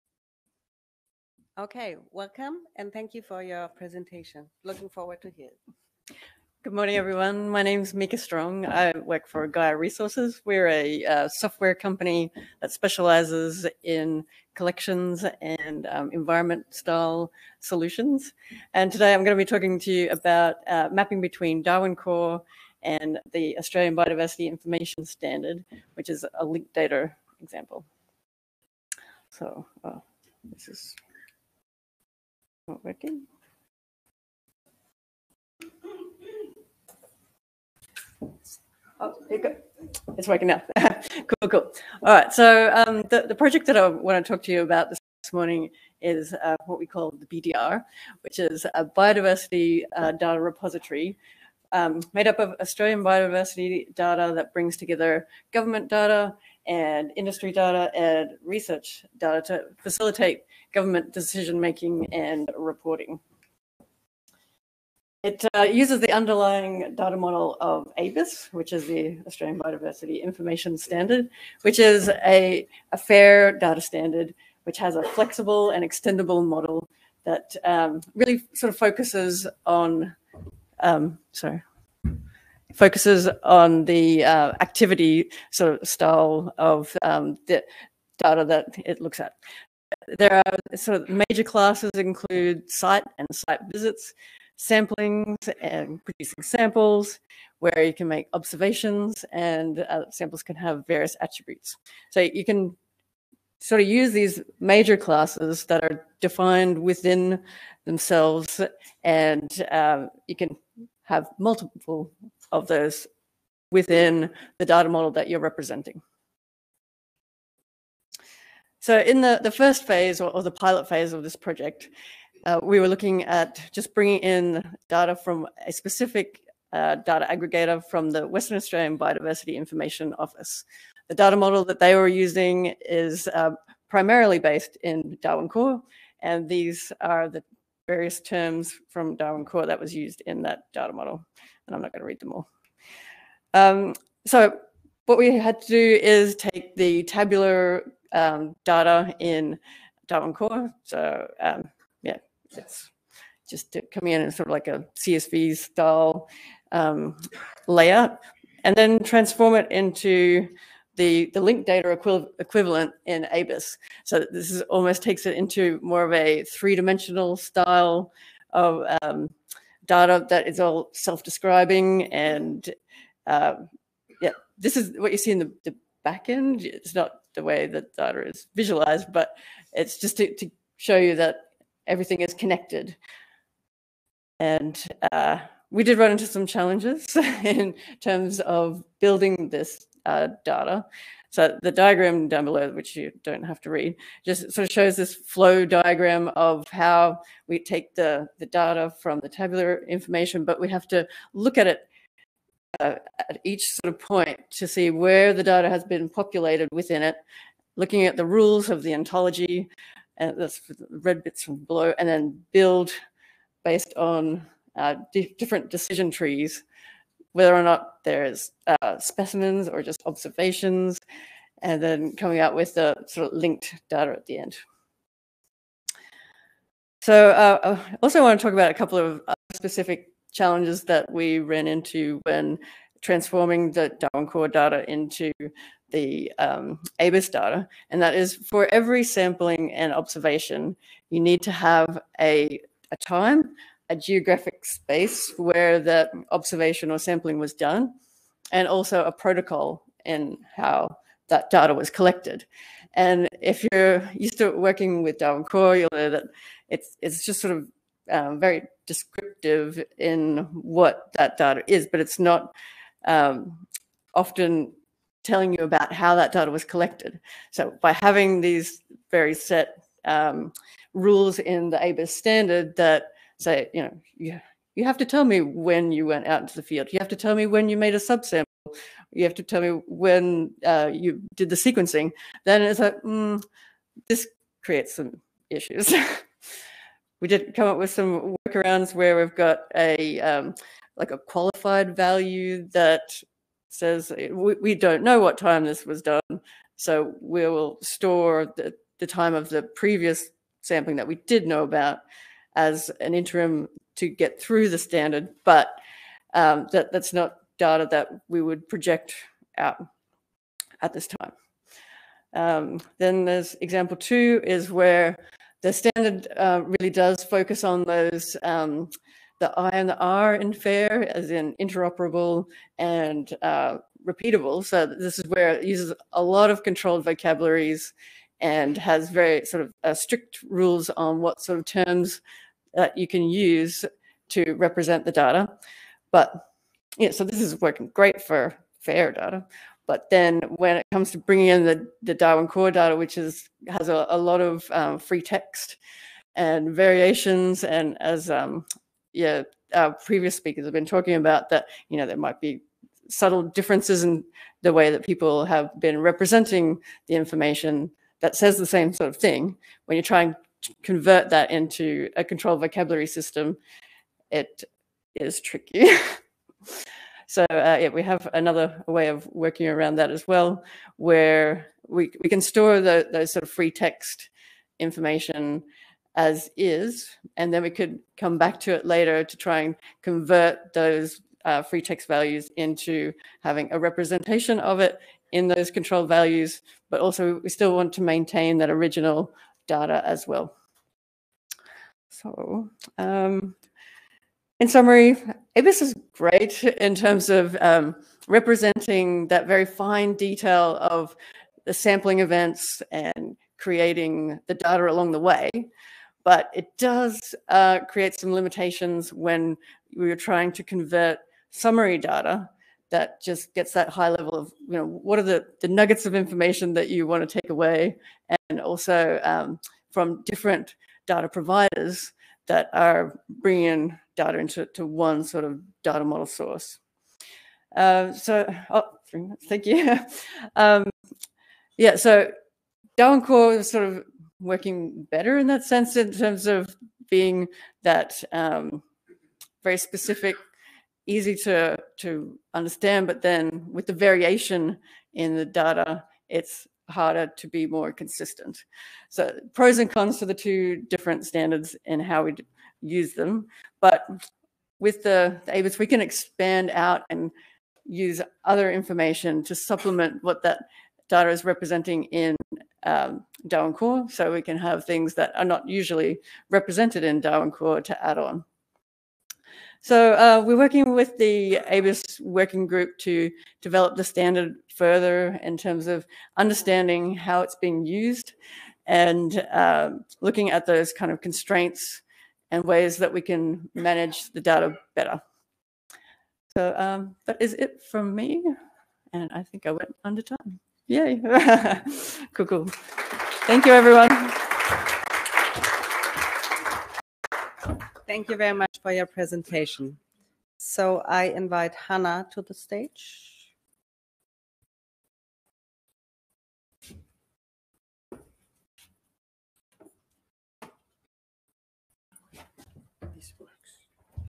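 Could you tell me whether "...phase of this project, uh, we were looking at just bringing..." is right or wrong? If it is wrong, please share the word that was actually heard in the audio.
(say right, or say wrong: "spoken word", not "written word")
right.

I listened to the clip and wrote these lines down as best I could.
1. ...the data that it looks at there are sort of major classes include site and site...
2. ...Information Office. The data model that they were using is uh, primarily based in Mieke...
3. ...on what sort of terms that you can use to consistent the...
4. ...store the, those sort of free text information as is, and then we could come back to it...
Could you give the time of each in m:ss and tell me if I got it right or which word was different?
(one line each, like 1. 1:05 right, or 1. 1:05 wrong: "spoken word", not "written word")
1. 1:27 right
2. 2:09 wrong: "Darwin", not "Mieke"
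3. 5:30 wrong: "represent", not "consistent"
4. 6:12 right.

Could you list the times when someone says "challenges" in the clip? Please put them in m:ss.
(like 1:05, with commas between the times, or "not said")
3:06, 3:50.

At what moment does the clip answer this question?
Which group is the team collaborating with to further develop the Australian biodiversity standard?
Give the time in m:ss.
7:51.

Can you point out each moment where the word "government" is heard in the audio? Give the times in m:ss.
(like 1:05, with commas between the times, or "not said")
0:55, 1:00.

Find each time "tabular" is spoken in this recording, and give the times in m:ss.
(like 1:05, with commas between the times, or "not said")
2:27, 3:19.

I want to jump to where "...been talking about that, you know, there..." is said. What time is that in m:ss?
5:50.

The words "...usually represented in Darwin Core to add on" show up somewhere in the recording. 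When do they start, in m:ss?
7:45.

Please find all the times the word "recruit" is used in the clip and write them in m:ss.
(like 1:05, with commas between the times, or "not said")
not said.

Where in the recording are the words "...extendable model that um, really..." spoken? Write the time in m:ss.
1:15.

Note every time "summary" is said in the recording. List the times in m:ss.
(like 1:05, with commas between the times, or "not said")
6:34, 6:51.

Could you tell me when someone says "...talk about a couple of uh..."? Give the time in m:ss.
3:48.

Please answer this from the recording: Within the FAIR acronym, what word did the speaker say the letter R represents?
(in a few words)
repeatable.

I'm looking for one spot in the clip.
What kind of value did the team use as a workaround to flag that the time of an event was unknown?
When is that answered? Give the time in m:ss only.
4:51.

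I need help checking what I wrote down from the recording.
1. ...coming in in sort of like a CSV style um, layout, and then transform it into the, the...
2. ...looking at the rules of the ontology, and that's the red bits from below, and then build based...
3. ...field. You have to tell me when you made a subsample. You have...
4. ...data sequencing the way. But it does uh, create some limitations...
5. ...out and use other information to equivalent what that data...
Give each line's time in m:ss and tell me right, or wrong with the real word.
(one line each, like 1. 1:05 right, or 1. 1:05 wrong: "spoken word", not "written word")
1. 2:33 right
2. 3:27 right
3. 4:36 right
4. 6:44 wrong: "along", not "sequencing"
5. 7:36 wrong: "supplement", not "equivalent".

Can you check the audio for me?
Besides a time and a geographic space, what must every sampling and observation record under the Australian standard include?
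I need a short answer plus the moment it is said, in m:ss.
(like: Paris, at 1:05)
a protocol, at 4:09.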